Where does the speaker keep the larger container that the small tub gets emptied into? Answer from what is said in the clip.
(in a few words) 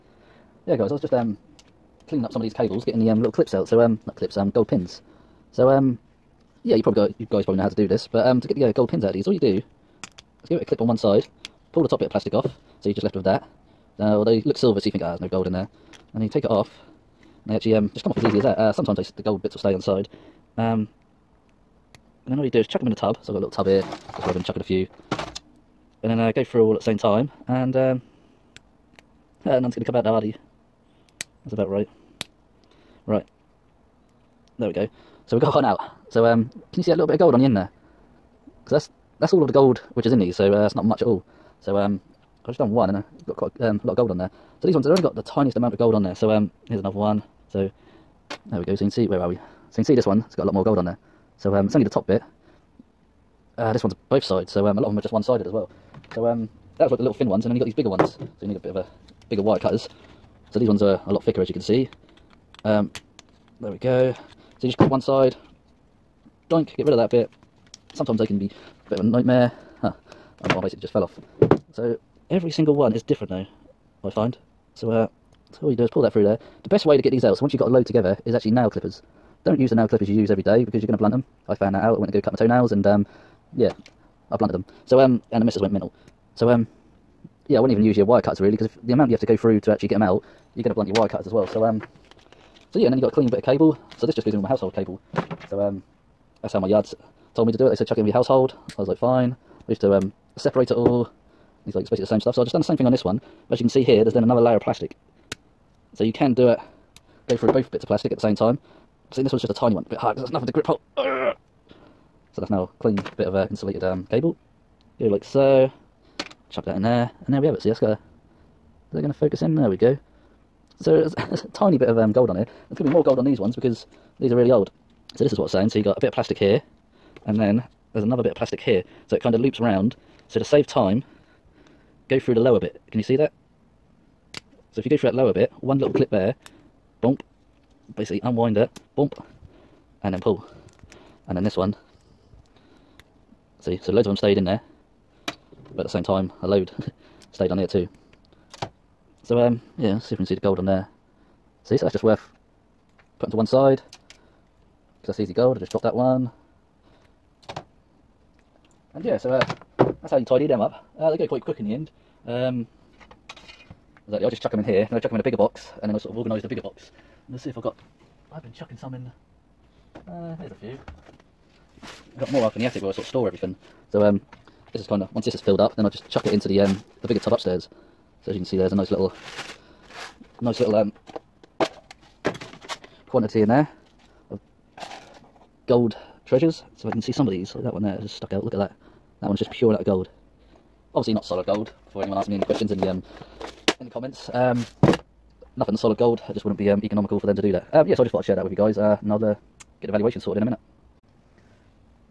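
the attic.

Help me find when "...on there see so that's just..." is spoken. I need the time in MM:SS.
02:30.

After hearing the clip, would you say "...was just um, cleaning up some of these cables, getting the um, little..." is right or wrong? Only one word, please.
right.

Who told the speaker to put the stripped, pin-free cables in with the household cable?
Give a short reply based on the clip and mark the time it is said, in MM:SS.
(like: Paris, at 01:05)
my yards, at 01:36.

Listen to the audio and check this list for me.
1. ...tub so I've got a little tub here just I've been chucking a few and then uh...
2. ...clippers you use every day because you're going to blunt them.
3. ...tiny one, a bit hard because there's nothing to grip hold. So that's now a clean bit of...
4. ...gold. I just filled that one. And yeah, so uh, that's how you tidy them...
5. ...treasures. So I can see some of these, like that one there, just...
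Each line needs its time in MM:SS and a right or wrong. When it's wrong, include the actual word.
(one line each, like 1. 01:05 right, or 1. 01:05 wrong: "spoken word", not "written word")
1. 00:22 right
2. 01:19 right
3. 01:49 right
4. 02:35 wrong: "dropped", not "filled"
5. 03:06 right.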